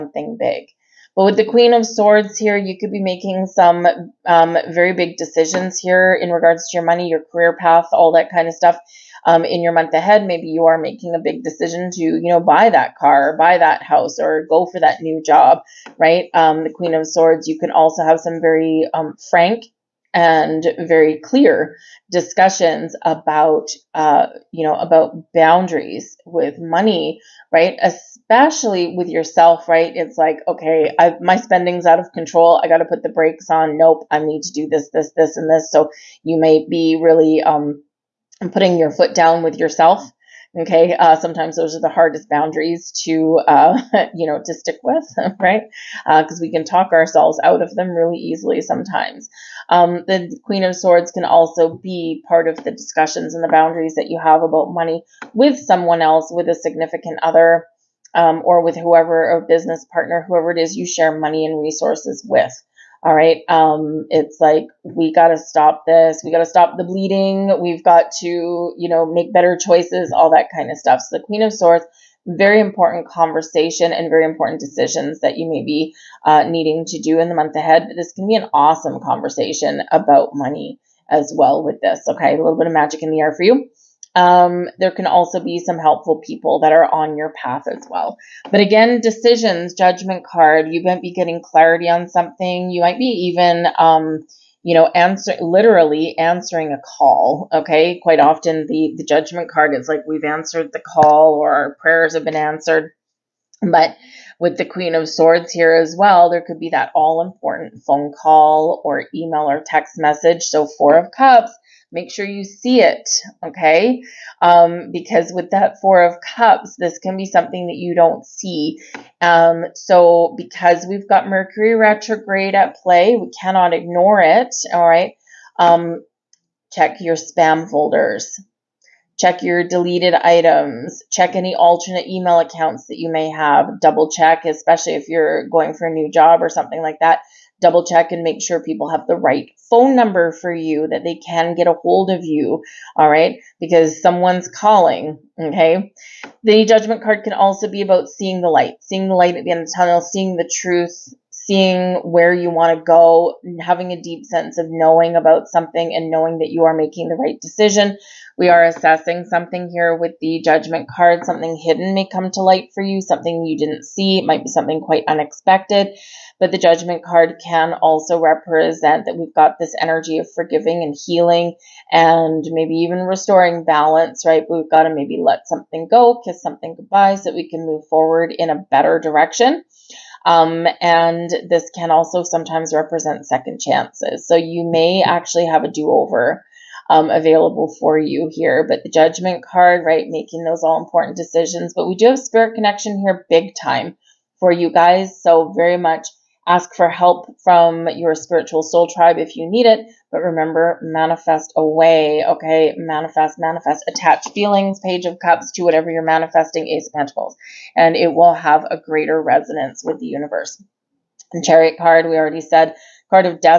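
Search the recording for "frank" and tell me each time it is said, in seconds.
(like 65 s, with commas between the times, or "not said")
19 s.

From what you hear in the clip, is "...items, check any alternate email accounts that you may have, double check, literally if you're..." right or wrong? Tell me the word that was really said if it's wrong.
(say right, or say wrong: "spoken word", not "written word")
wrong: "especially", not "literally".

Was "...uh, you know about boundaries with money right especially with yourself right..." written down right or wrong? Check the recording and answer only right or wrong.
right.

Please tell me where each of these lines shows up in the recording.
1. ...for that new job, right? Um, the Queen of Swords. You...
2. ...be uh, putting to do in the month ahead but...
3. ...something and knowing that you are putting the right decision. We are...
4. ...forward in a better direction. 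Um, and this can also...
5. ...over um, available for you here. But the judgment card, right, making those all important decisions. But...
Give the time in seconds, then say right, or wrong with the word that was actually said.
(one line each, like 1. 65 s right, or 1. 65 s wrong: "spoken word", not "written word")
1. 14 s right
2. 75 s wrong: "needing", not "putting"
3. 155 s wrong: "making", not "putting"
4. 177 s right
5. 185 s right.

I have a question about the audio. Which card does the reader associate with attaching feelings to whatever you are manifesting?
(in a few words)
Page of Cups.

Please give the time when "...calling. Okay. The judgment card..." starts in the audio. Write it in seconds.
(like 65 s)
144 s.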